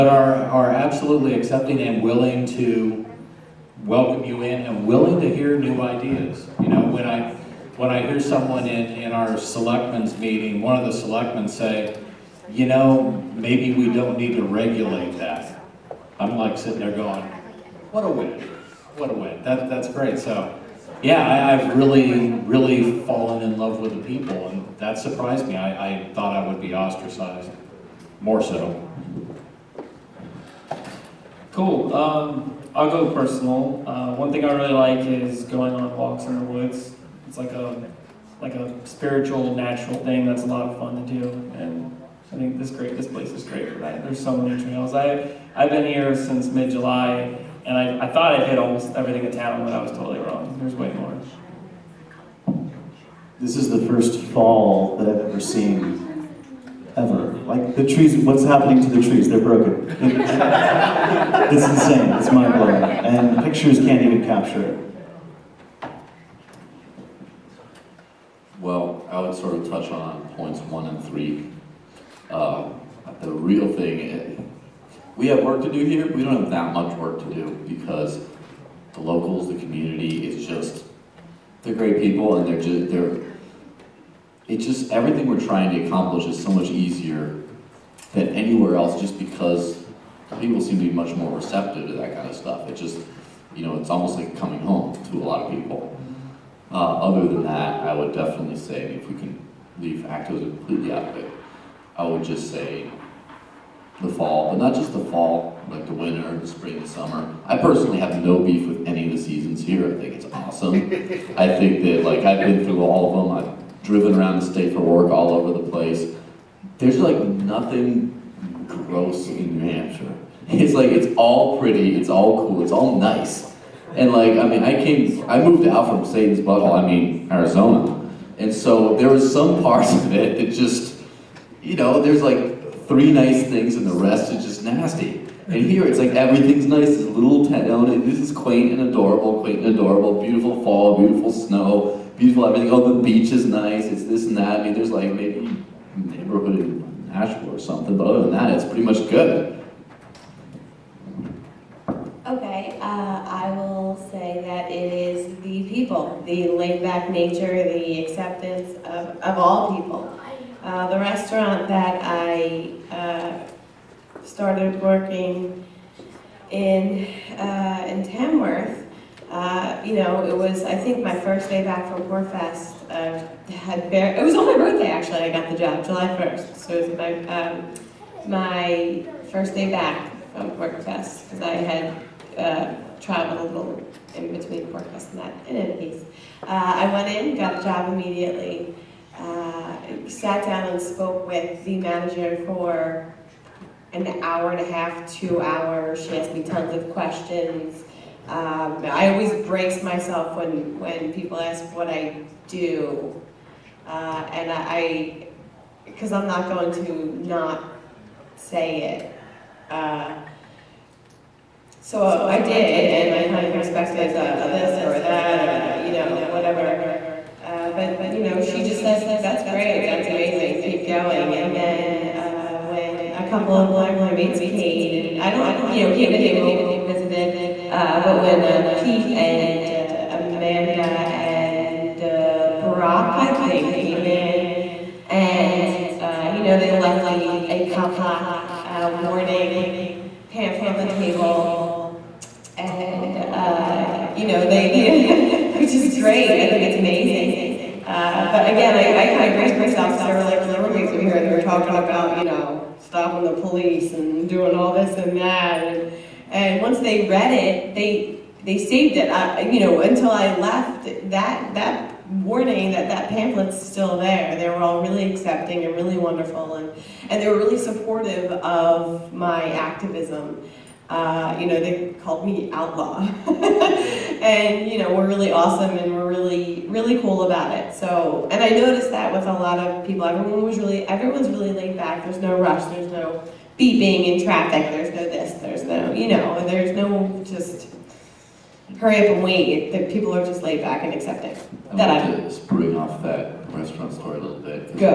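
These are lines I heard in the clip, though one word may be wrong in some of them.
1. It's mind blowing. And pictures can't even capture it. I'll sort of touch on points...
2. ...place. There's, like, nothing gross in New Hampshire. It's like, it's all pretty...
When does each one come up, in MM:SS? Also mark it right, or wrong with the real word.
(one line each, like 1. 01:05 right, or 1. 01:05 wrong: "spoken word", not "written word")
1. 01:02 right
2. 01:55 right.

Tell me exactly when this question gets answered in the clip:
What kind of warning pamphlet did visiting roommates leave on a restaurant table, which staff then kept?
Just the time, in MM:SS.
03:57.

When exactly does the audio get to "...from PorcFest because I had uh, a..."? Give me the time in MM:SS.
03:00.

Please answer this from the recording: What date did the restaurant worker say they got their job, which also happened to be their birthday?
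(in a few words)
July 1.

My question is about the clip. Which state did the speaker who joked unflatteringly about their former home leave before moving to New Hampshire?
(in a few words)
Arizona.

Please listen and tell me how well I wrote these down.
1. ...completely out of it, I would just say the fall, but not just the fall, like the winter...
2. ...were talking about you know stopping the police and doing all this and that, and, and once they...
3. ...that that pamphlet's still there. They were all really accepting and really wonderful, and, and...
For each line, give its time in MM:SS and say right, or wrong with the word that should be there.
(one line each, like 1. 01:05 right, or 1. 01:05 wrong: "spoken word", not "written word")
1. 01:40 right
2. 04:11 right
3. 04:22 right.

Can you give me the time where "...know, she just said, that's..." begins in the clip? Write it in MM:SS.
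03:38.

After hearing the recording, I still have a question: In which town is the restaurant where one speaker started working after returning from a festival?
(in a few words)
Tamworth.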